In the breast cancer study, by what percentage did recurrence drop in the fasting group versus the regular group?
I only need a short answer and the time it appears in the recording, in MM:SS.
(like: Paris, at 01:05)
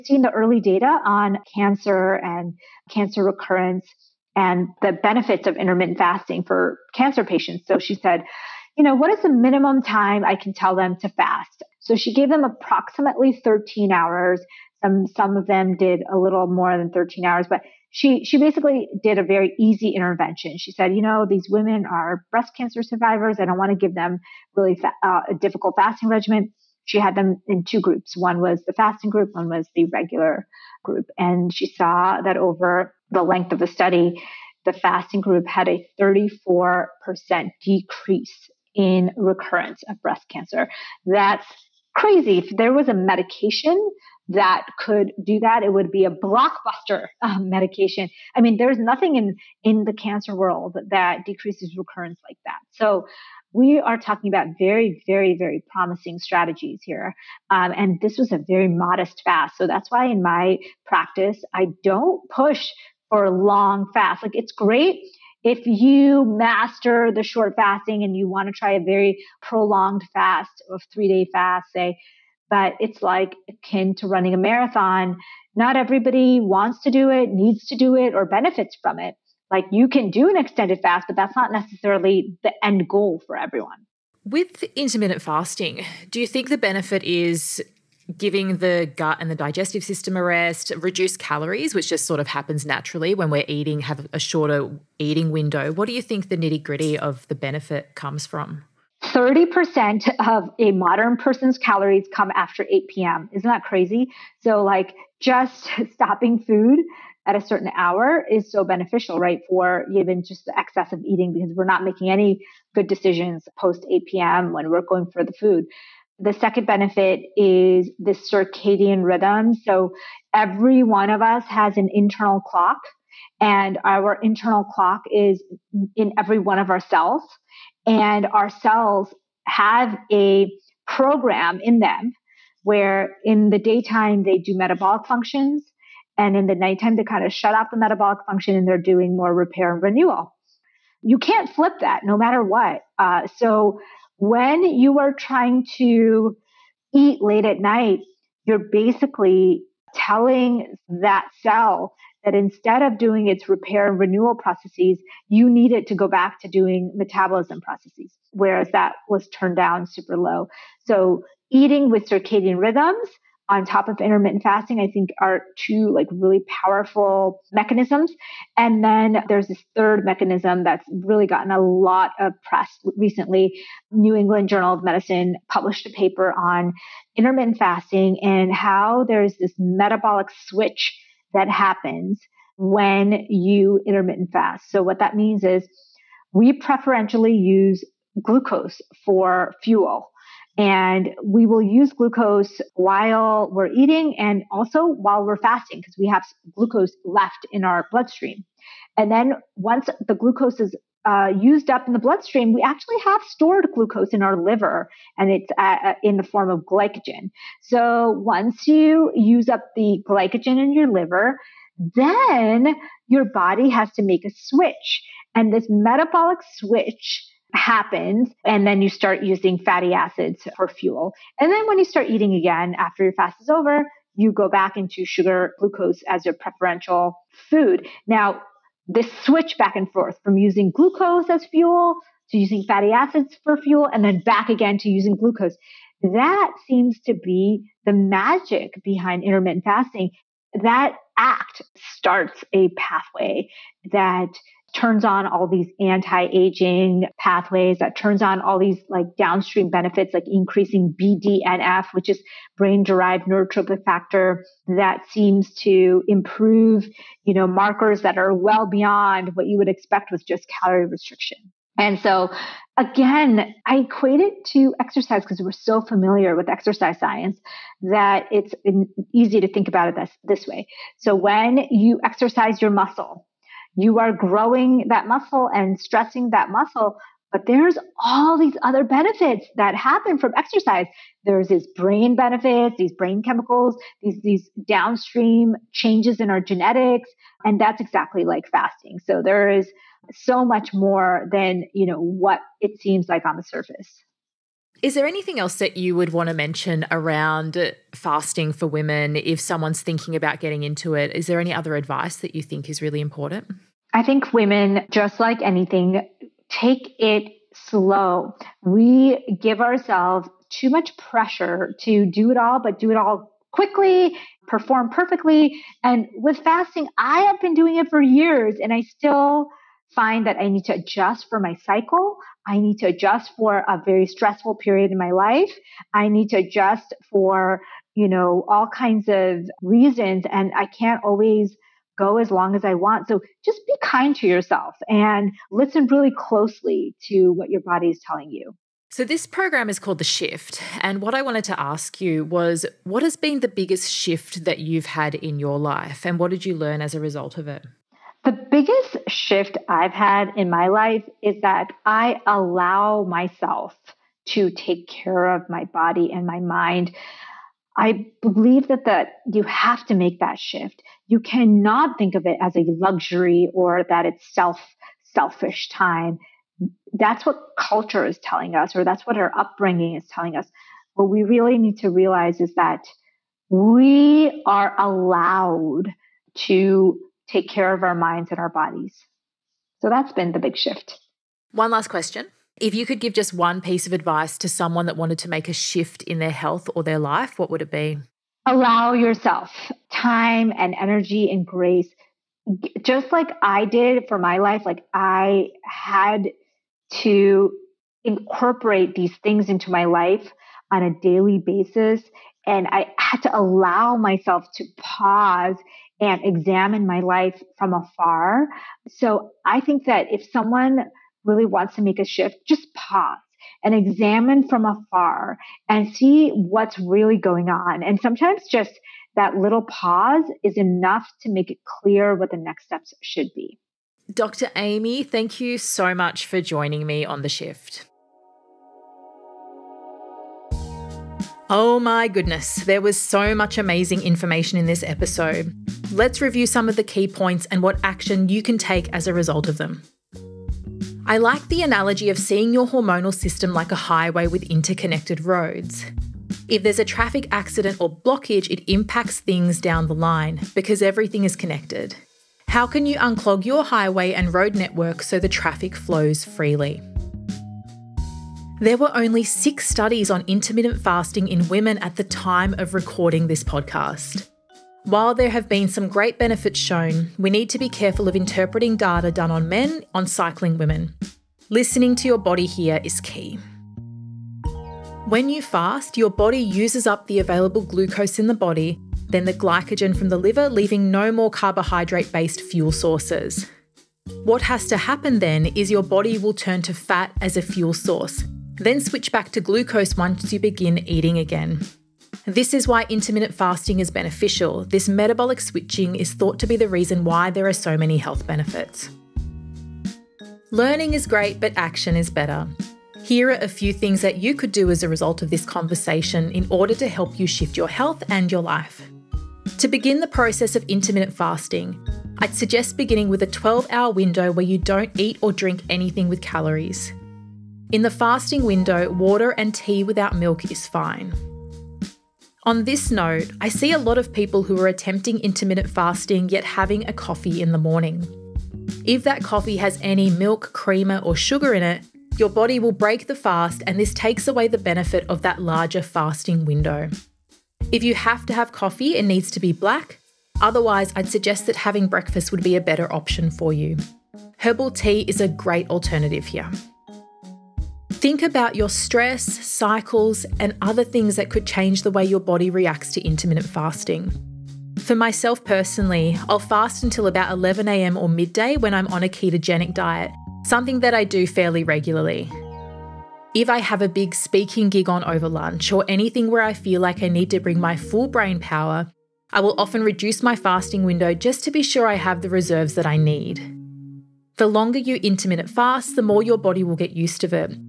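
34%, at 00:36.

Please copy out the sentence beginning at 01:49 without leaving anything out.
For even just the excess of eating because we're not making any good decisions post 8 p.m.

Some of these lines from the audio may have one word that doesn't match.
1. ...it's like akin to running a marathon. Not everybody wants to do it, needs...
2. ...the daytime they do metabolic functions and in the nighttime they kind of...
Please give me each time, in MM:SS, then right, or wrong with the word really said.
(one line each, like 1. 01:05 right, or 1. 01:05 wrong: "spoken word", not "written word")
1. 01:12 right
2. 02:13 right.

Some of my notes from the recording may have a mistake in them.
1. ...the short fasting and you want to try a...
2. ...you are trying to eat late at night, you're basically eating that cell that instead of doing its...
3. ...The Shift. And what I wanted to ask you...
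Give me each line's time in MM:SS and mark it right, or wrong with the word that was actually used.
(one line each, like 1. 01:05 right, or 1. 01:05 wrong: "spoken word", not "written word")
1. 01:07 right
2. 02:24 wrong: "telling", not "eating"
3. 05:39 right.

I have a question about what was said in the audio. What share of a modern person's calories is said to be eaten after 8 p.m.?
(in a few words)
30%.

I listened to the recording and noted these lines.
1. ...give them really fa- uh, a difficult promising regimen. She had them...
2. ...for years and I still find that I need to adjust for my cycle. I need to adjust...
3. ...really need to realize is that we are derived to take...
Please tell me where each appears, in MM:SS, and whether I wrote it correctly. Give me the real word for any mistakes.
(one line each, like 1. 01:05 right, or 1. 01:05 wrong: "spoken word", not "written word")
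1. 00:23 wrong: "fasting", not "promising"
2. 05:17 right
3. 06:11 wrong: "allowed", not "derived".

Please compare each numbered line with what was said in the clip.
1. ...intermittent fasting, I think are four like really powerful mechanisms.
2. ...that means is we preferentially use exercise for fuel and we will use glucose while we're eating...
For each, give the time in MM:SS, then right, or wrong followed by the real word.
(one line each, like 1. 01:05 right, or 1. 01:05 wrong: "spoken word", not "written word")
1. 02:44 wrong: "two", not "four"
2. 03:04 wrong: "glucose", not "exercise".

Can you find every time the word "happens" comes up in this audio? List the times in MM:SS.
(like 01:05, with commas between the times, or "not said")
01:32, 03:01, 03:37, 04:39, 08:04.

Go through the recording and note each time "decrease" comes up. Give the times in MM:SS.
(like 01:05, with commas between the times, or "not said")
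00:37, 00:51.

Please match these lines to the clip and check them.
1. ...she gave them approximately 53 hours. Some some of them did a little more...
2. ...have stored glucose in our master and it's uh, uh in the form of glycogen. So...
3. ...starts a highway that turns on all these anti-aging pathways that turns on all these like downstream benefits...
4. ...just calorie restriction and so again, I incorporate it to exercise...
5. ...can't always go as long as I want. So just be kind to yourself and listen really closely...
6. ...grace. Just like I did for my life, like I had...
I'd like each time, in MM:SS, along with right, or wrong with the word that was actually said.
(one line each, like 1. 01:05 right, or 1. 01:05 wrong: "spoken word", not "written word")
1. 00:11 wrong: "13", not "53"
2. 03:23 wrong: "liver", not "master"
3. 04:01 wrong: "pathway", not "highway"
4. 04:20 wrong: "equate", not "incorporate"
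5. 05:30 right
6. 06:31 right.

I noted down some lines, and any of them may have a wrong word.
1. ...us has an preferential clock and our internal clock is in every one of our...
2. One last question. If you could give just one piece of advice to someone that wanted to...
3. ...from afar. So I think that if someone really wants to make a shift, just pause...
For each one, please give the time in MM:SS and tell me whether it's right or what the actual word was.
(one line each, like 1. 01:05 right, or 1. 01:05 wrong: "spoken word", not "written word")
1. 02:01 wrong: "internal", not "preferential"
2. 06:21 right
3. 06:47 right.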